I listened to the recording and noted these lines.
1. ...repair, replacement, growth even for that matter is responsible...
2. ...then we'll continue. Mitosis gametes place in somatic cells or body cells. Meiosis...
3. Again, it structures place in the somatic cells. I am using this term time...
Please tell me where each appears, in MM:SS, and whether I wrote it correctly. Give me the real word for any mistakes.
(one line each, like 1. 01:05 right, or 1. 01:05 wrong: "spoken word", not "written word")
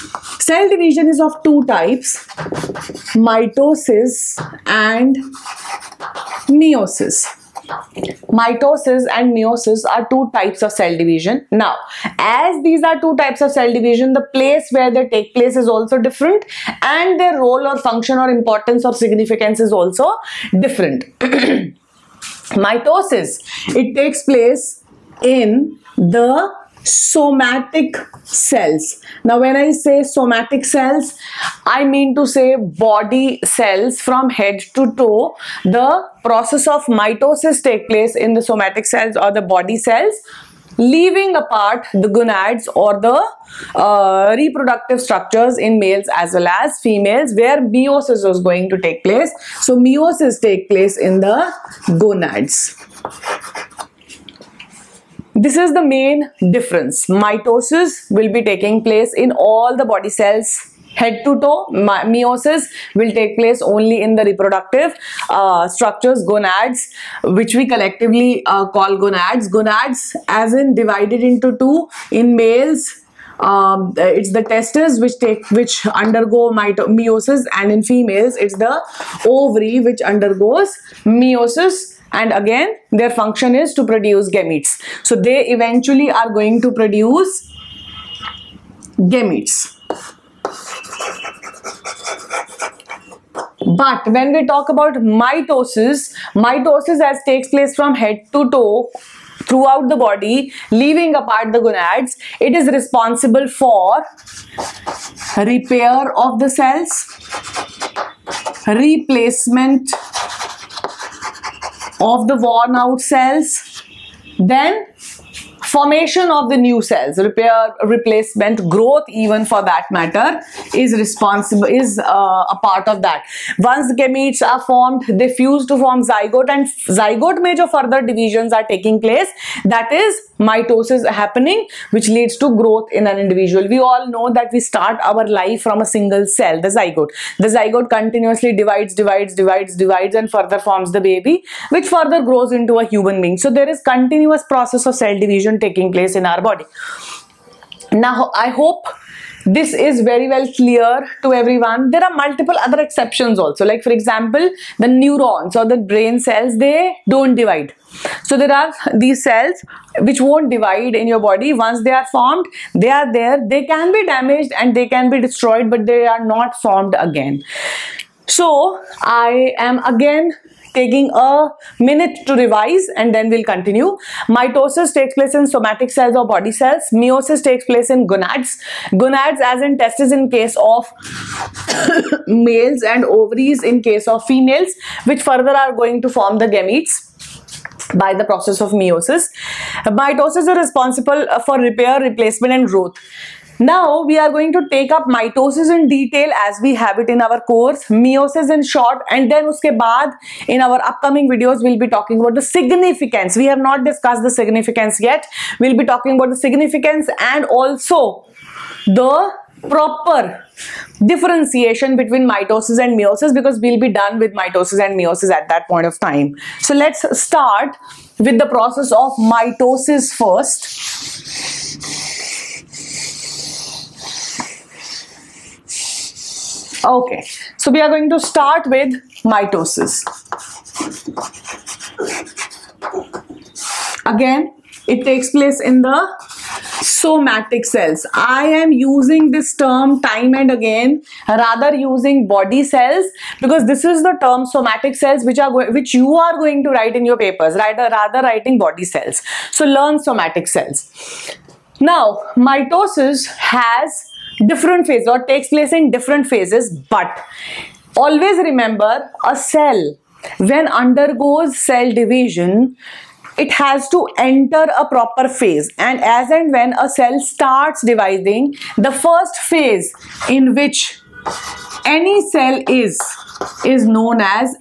1. 01:57 right
2. 02:53 wrong: "takes", not "gametes"
3. 03:54 wrong: "takes", not "structures".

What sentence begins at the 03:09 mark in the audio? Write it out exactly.
Mitosis is responsible for repair, replacement and growth.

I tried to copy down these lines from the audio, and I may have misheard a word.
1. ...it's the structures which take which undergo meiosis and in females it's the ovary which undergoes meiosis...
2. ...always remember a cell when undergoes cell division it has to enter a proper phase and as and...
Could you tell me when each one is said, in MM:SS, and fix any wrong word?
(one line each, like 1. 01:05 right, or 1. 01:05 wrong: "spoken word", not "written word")
1. 01:13 wrong: "testes", not "structures"
2. 04:17 right.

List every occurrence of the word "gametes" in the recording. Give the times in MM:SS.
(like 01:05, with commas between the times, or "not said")
01:24, 01:29, 02:03, 03:06.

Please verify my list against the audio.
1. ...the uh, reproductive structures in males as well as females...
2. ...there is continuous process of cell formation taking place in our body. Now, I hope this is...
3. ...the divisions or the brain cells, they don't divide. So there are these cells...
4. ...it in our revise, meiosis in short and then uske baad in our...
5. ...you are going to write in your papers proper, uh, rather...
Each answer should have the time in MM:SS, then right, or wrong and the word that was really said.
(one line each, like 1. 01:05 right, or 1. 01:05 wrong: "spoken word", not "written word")
1. 00:42 right
2. 02:23 wrong: "division", not "formation"
3. 02:34 wrong: "neurons", not "divisions"
4. 03:16 wrong: "course", not "revise"
5. 04:05 wrong: "rather", not "proper".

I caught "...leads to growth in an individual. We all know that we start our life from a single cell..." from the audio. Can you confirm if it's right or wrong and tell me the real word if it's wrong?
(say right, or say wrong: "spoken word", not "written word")
right.